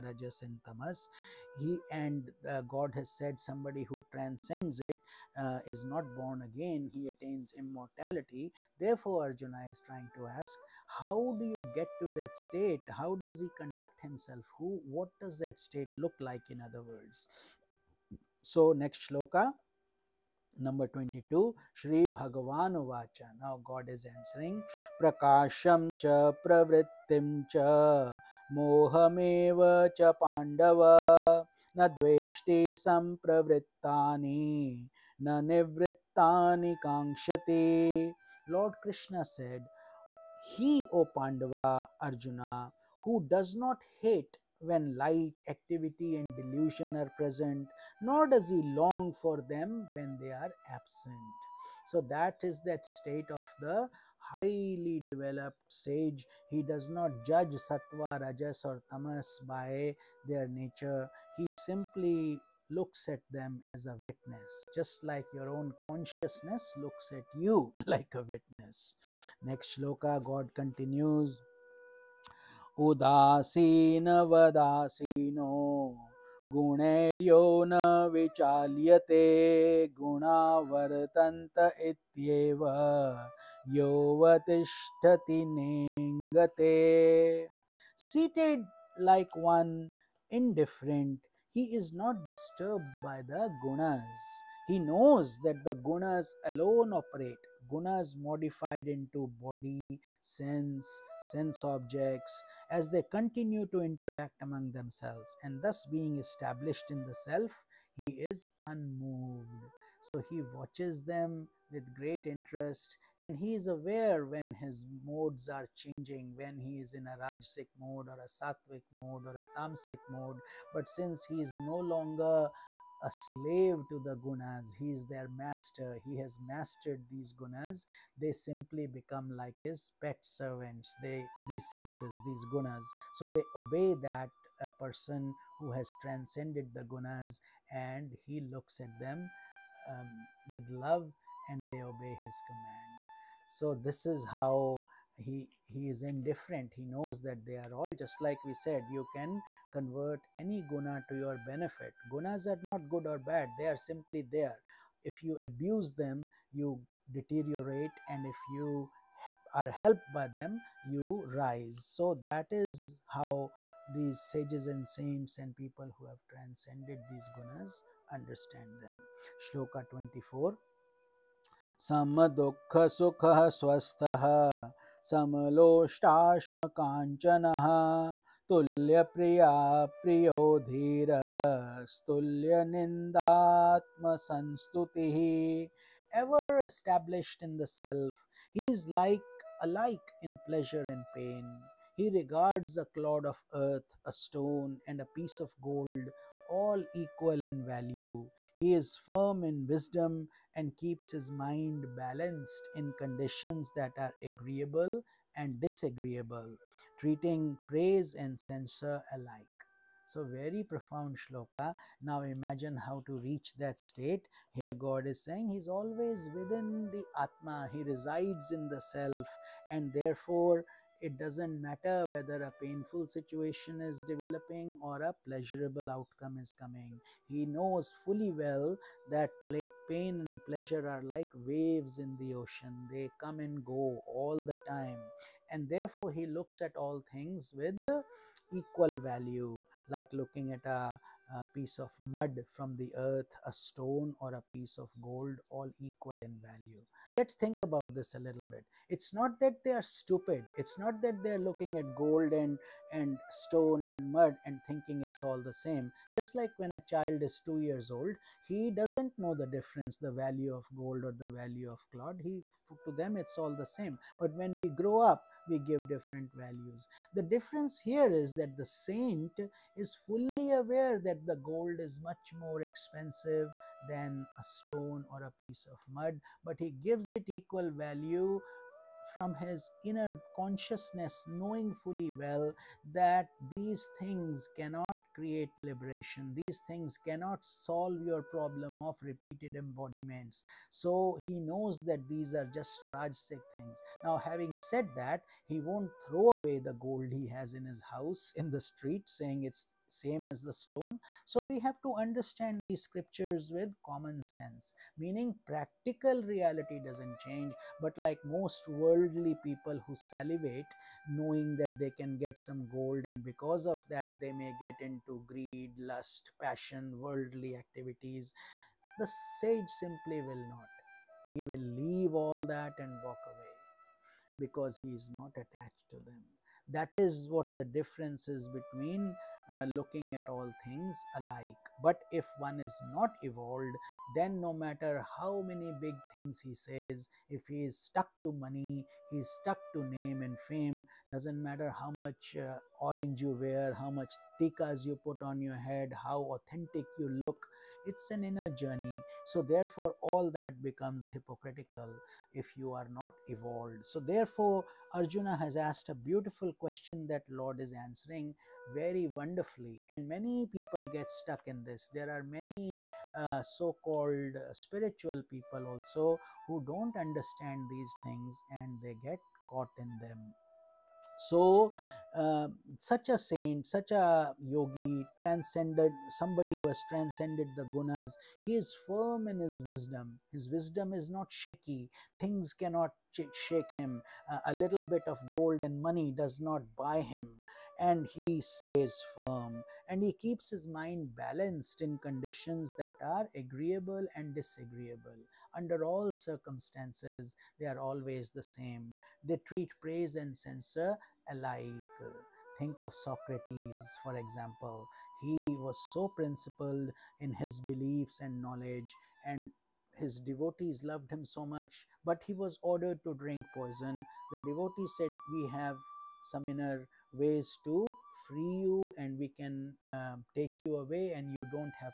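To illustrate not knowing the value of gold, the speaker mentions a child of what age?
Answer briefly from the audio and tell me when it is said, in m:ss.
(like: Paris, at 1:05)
2 years old, at 4:17.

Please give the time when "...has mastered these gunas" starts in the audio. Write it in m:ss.
2:06.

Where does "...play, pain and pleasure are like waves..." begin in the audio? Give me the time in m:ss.
3:49.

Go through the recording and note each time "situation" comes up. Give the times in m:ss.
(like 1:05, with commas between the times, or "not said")
3:43.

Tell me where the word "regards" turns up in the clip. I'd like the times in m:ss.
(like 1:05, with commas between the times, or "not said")
3:12.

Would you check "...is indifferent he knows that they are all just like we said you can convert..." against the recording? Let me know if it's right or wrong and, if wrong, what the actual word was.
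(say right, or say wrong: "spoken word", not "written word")
right.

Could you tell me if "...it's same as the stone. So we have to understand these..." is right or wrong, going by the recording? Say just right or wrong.
right.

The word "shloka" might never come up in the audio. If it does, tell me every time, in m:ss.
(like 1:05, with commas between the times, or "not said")
0:19, 1:09, 2:49, 3:31.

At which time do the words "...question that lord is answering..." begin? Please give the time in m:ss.
5:56.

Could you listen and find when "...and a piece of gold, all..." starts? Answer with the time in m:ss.
3:14.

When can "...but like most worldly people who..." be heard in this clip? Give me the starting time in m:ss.
5:07.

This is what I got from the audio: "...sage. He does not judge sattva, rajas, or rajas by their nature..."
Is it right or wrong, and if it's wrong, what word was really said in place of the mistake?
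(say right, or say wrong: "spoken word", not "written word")
wrong: "tamas", not "rajas".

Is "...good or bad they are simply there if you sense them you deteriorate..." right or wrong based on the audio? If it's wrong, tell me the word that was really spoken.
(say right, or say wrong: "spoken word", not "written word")
wrong: "abuse", not "sense".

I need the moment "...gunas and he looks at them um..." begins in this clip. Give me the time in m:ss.
2:16.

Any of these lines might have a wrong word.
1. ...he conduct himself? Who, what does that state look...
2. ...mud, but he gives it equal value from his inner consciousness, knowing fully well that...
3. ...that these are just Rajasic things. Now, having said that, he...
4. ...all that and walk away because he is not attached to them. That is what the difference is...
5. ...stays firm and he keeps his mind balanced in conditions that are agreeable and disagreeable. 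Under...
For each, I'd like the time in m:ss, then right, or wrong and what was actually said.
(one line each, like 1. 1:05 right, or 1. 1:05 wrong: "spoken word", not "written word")
1. 0:13 right
2. 4:35 right
3. 4:51 right
4. 5:22 right
5. 6:28 right.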